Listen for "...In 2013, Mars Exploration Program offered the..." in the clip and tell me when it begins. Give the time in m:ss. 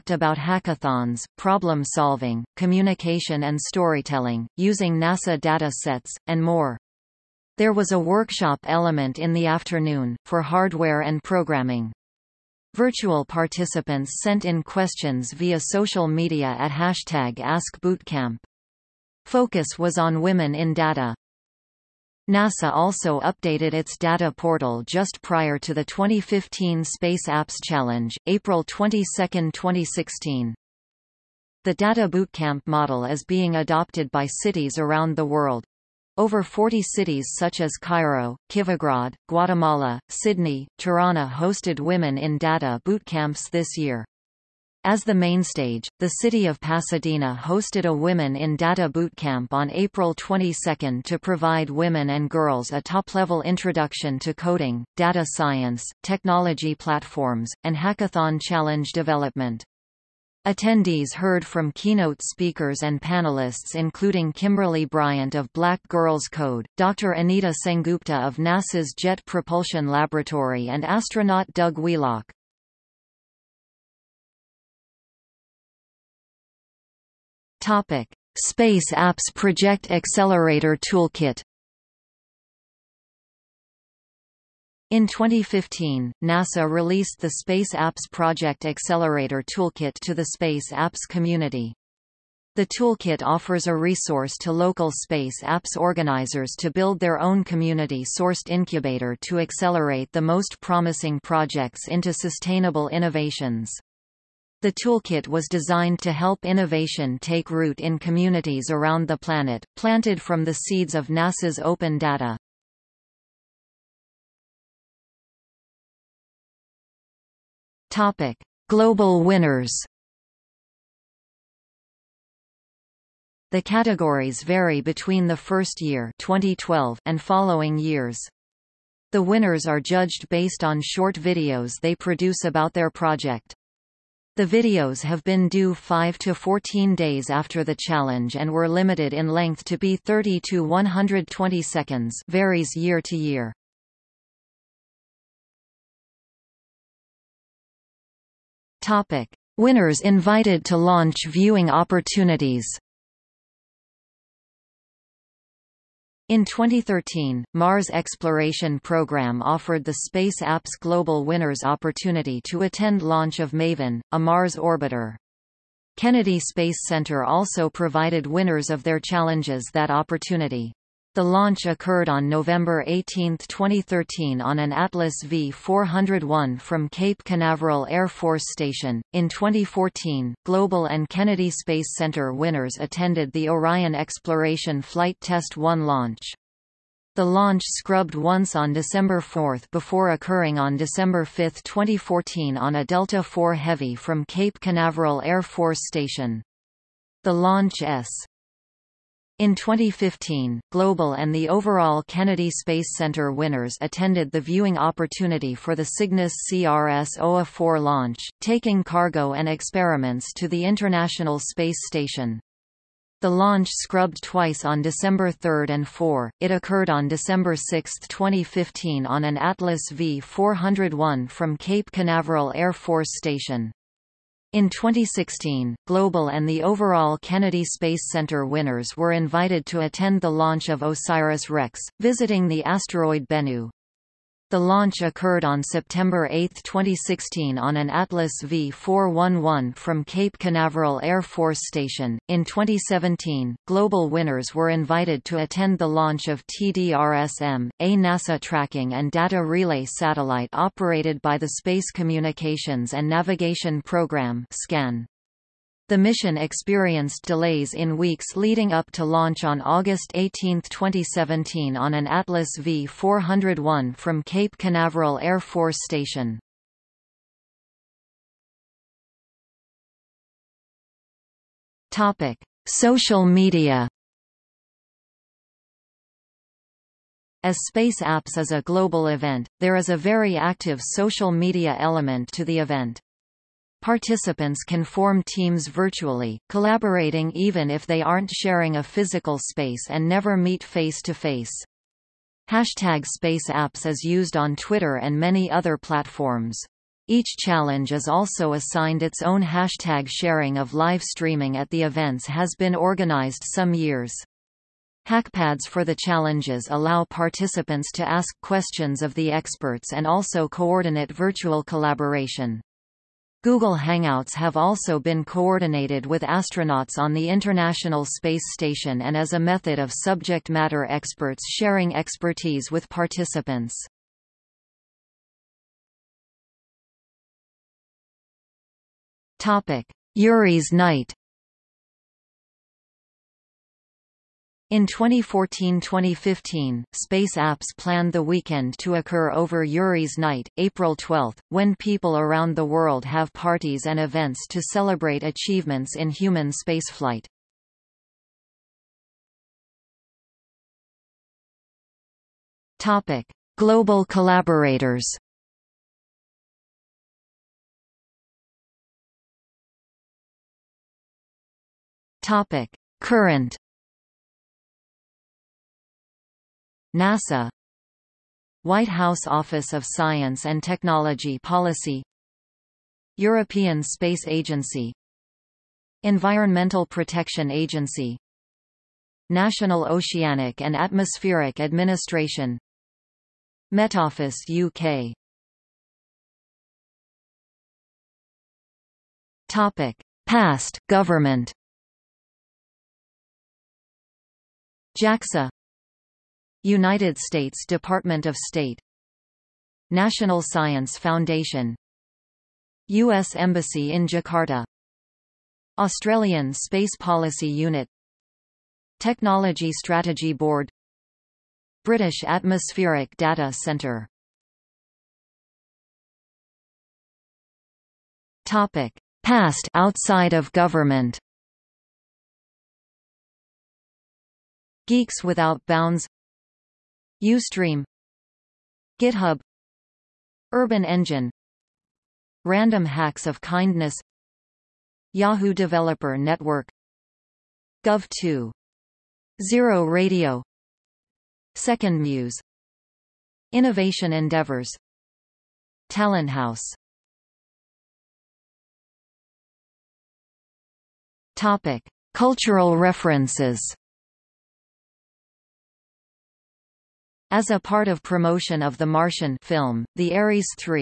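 2:36.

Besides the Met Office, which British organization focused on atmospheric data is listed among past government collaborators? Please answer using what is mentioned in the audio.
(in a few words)
British Atmospheric Data Centre.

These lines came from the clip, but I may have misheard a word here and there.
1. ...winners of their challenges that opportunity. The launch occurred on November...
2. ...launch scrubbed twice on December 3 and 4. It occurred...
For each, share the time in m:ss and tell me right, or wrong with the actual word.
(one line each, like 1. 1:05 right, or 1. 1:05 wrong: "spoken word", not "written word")
1. 2:48 right
2. 3:33 right.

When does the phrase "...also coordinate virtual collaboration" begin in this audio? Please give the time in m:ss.
5:10.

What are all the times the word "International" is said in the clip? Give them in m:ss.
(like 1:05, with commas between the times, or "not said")
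3:30, 5:17.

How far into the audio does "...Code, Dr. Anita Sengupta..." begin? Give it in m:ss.
1:06.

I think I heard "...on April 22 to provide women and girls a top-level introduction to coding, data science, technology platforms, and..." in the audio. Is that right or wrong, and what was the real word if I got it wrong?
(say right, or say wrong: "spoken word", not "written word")
right.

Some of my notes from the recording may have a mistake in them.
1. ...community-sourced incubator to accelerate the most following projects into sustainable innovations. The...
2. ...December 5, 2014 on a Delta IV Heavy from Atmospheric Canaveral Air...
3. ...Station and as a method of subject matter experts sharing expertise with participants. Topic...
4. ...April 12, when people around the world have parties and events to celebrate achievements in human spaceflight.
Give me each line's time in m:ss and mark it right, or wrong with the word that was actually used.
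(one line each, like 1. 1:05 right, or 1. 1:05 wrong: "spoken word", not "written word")
1. 1:37 wrong: "promising", not "following"
2. 3:10 wrong: "Cape", not "Atmospheric"
3. 5:18 right
4. 5:40 right.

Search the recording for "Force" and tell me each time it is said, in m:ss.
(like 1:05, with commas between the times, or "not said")
2:58, 3:15, 3:42, 4:01, 4:25.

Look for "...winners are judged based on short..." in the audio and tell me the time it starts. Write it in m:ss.
2:09.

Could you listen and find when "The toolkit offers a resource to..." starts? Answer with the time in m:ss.
1:32.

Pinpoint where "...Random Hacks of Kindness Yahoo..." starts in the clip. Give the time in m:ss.
7:12.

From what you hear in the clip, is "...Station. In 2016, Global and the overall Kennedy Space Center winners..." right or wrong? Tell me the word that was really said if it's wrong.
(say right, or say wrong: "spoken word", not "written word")
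right.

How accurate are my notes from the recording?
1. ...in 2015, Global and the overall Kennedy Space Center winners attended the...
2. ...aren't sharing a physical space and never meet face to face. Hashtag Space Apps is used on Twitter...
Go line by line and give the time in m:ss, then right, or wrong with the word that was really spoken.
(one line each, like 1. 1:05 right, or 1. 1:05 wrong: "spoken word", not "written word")
1. 3:19 right
2. 4:48 right.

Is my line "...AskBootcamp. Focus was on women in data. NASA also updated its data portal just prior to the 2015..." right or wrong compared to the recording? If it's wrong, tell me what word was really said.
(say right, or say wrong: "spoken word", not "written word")
right.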